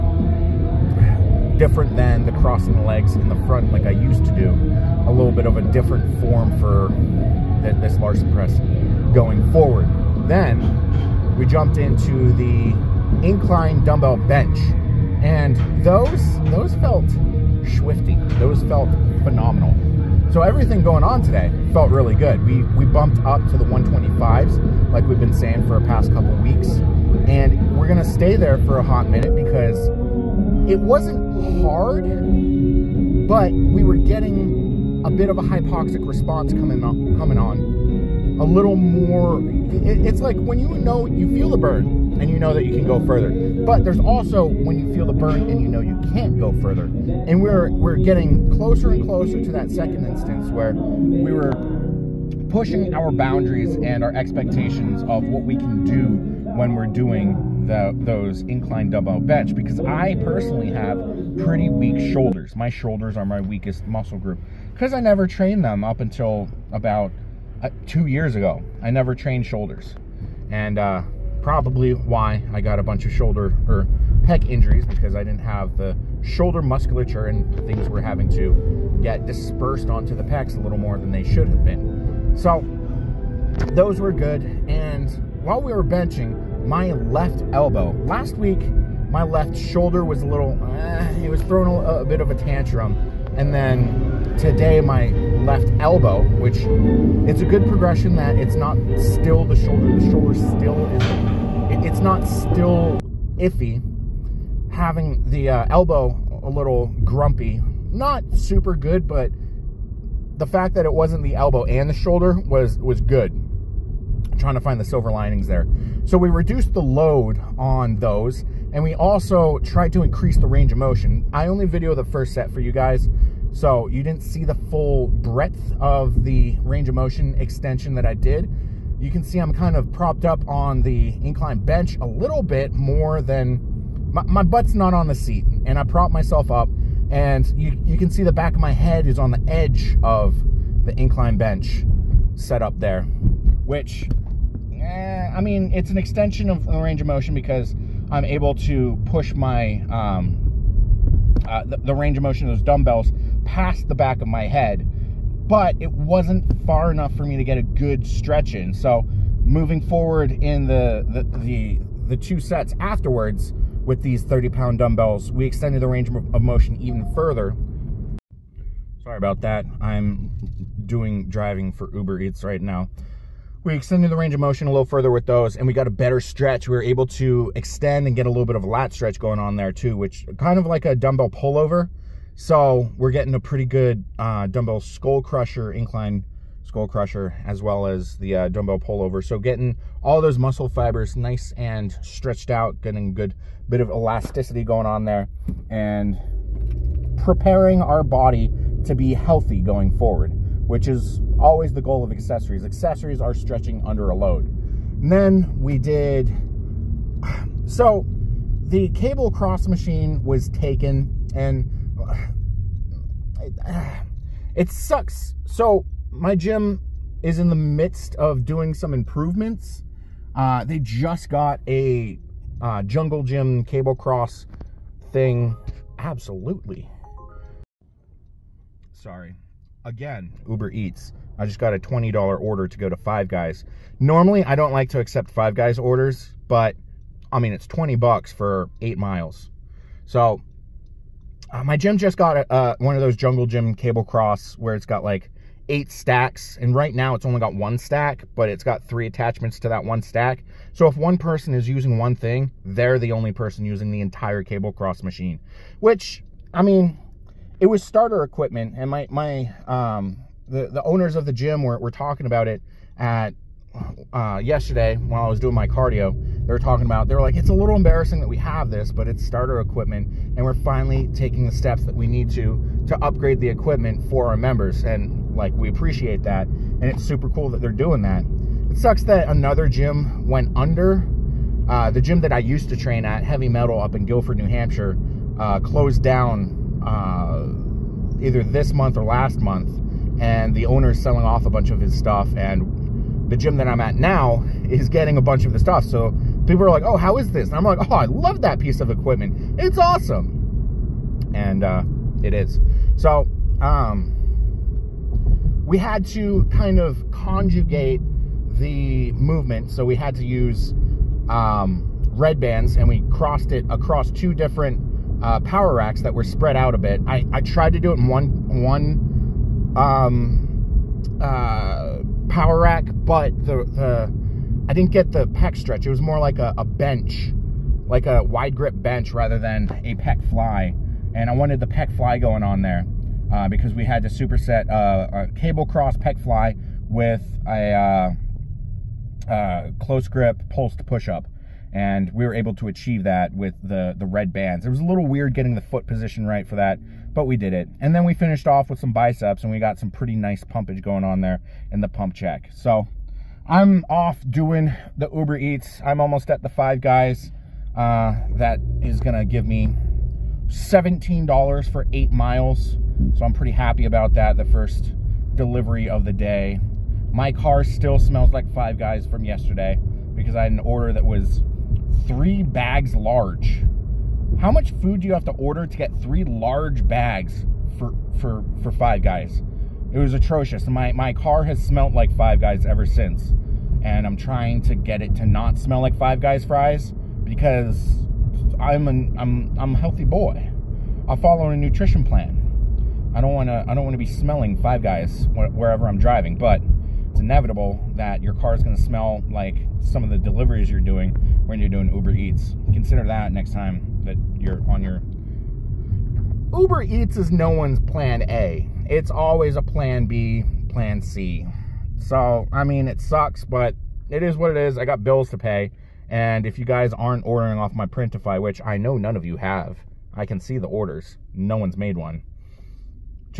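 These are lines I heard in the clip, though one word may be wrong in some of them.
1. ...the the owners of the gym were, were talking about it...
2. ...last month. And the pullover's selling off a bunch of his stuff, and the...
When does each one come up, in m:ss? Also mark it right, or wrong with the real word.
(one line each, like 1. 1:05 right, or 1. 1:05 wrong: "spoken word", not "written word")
1. 4:20 right
2. 4:49 wrong: "owner", not "pullover".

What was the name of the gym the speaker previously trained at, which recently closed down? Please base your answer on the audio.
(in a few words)
Heavy Metal.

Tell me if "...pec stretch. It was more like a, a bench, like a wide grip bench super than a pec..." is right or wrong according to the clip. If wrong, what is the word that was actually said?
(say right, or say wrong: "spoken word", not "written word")
wrong: "rather", not "super".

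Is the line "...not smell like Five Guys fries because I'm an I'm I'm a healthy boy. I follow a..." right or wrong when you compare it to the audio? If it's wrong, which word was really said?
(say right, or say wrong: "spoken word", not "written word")
right.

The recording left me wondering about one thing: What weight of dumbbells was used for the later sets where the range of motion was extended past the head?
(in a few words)
30 pounds.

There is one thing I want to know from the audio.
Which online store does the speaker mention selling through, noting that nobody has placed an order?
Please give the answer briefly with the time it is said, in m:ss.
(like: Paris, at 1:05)
Printify, at 6:57.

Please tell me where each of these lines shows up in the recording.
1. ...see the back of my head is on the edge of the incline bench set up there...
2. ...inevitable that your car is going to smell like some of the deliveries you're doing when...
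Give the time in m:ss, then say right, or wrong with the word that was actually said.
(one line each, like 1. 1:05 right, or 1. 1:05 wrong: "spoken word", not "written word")
1. 2:18 right
2. 6:37 right.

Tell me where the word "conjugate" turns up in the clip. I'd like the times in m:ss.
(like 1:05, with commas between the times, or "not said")
5:07.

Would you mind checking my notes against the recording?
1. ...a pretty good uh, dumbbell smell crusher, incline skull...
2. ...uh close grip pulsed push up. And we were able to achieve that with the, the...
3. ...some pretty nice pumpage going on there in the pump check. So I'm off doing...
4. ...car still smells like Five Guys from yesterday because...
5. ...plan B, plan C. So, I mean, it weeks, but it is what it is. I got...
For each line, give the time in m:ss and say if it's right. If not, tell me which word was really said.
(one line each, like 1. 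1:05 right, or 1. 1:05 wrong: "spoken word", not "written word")
1. 3:03 wrong: "skull", not "smell"
2. 5:39 right
3. 5:49 right
4. 6:07 right
5. 6:49 wrong: "sucks", not "weeks".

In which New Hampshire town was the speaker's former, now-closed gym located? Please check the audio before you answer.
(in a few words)
Gilford.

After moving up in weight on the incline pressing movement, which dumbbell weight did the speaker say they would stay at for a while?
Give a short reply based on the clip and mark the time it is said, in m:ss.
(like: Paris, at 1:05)
125s, at 0:23.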